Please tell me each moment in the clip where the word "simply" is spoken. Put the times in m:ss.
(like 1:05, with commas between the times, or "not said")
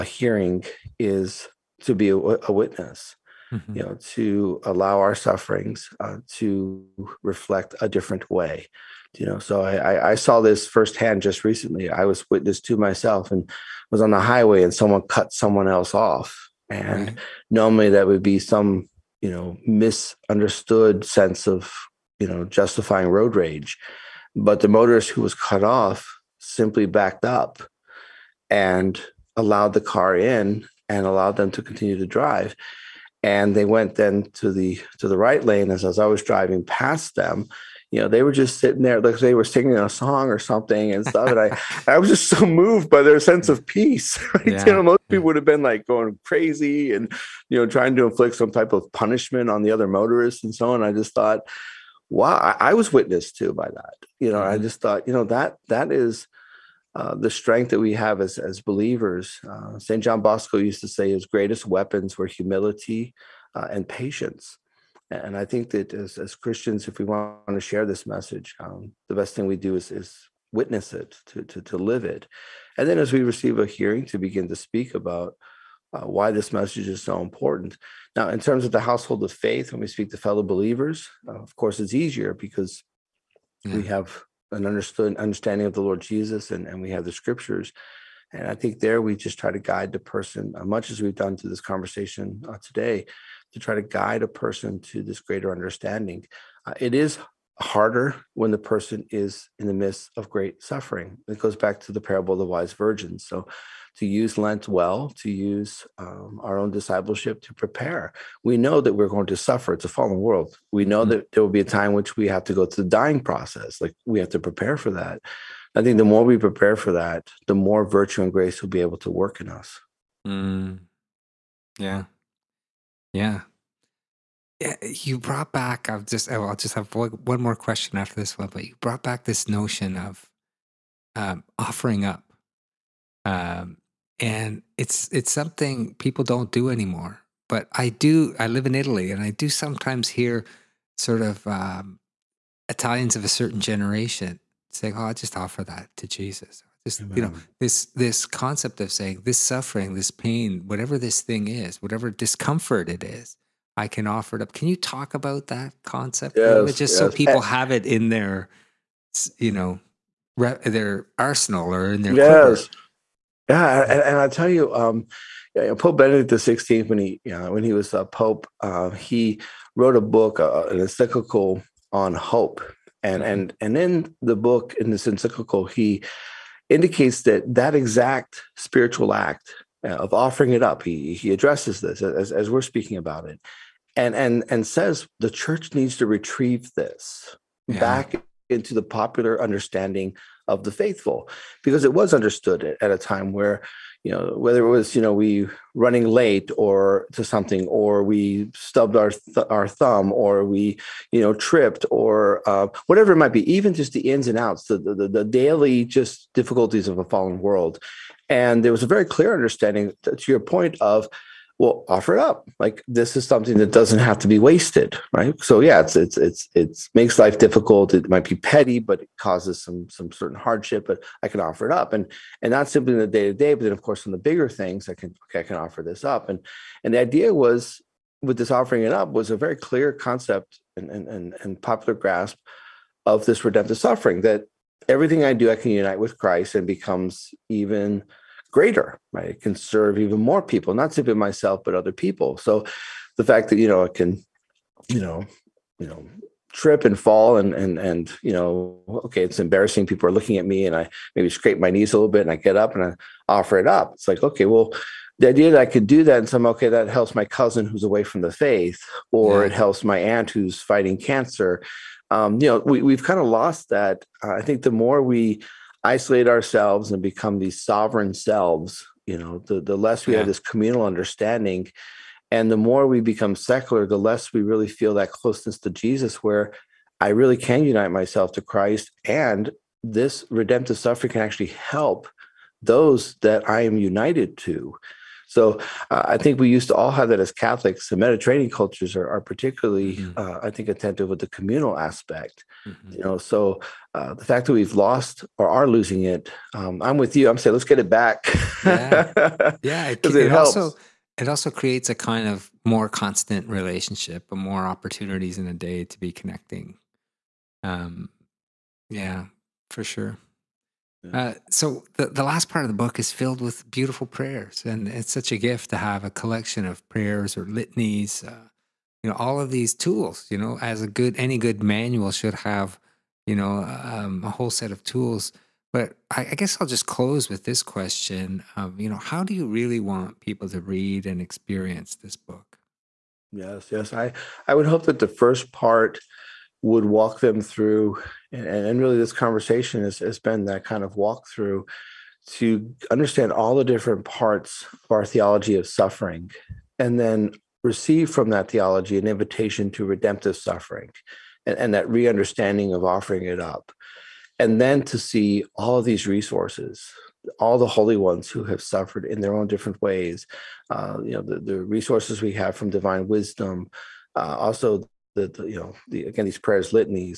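0:26, 3:42, 4:00.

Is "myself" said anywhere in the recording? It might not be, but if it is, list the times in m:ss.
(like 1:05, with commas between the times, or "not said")
0:12, 4:01, 4:37.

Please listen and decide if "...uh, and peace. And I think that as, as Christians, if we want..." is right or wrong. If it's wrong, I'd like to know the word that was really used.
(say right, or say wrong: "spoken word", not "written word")
wrong: "patience", not "peace".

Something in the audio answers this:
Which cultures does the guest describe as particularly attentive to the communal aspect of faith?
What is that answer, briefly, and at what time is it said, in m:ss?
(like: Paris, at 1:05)
Mediterranean cultures, at 4:47.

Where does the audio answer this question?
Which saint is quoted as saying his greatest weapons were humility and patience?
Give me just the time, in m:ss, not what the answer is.
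0:59.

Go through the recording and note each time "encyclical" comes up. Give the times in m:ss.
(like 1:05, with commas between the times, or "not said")
2:50, 2:55.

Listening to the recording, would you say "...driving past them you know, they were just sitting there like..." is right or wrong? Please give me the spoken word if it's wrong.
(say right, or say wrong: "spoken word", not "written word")
right.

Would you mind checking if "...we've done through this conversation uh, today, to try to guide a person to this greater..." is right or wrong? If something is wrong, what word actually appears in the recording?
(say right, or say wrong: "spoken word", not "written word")
right.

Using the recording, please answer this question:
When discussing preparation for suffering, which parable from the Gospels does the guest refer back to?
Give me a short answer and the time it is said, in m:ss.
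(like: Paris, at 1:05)
The parable of the wise virgin, at 1:41.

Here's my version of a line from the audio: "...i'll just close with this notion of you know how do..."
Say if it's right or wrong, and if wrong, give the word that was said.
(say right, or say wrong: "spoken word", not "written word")
wrong: "question", not "notion".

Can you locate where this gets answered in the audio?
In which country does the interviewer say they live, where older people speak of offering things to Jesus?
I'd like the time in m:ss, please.
2:18.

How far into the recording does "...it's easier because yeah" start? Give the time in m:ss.
1:21.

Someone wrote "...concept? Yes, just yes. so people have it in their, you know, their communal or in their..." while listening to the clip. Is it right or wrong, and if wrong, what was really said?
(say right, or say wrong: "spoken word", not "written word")
wrong: "arsenal", not "communal".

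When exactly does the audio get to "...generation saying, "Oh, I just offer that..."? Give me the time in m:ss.
2:23.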